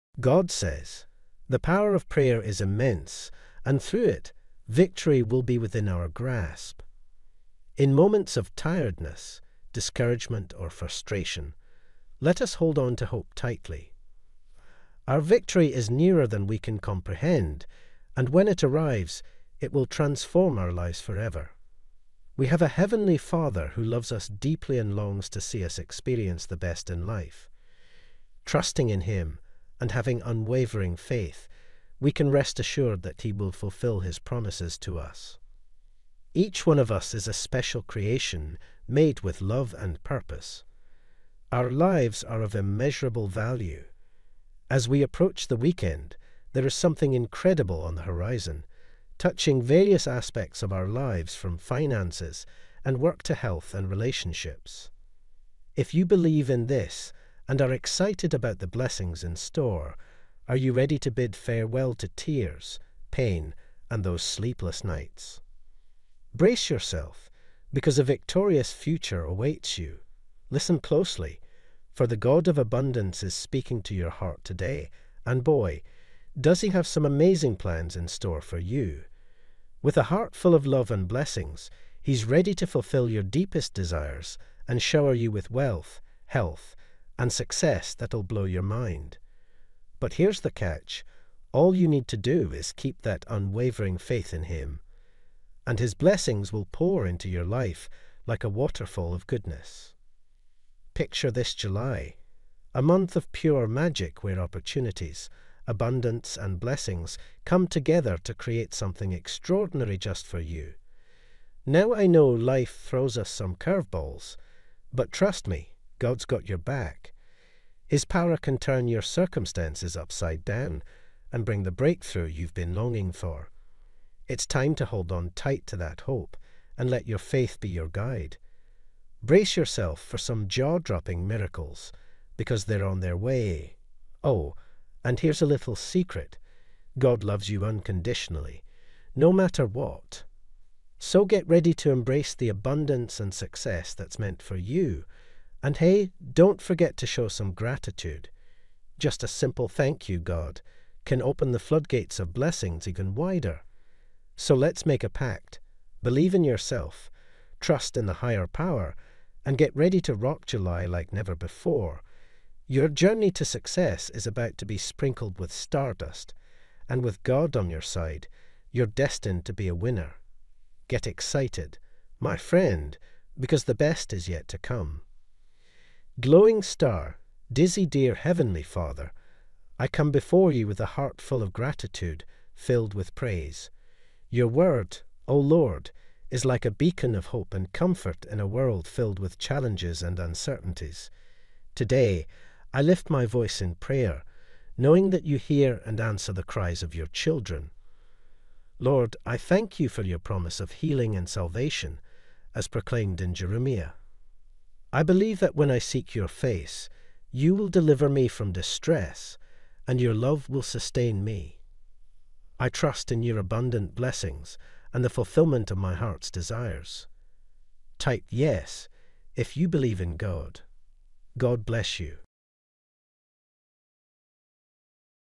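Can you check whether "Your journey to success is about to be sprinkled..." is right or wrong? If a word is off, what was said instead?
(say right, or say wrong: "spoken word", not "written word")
right.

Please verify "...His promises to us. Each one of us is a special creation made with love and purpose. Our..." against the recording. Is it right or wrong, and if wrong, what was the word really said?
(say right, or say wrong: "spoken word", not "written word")
right.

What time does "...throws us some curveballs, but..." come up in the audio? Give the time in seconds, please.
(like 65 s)
112 s.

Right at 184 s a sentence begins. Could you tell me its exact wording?
Your word, O Lord, is like a beacon of hope and comfort in a world filled with challenges and uncertainties.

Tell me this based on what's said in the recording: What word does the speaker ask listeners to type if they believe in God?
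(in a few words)
yes.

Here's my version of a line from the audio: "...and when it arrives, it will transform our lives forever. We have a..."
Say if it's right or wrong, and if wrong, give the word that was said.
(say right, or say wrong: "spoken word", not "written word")
right.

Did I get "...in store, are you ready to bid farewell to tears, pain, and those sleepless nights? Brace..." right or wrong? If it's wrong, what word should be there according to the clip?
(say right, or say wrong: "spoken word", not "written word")
right.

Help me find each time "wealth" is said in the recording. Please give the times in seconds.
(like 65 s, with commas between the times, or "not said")
85 s.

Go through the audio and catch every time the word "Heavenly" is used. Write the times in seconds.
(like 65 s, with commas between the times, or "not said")
22 s, 178 s.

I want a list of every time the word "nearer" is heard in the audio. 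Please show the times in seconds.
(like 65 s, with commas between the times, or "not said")
15 s.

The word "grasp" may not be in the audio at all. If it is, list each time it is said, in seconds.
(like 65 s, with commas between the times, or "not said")
6 s.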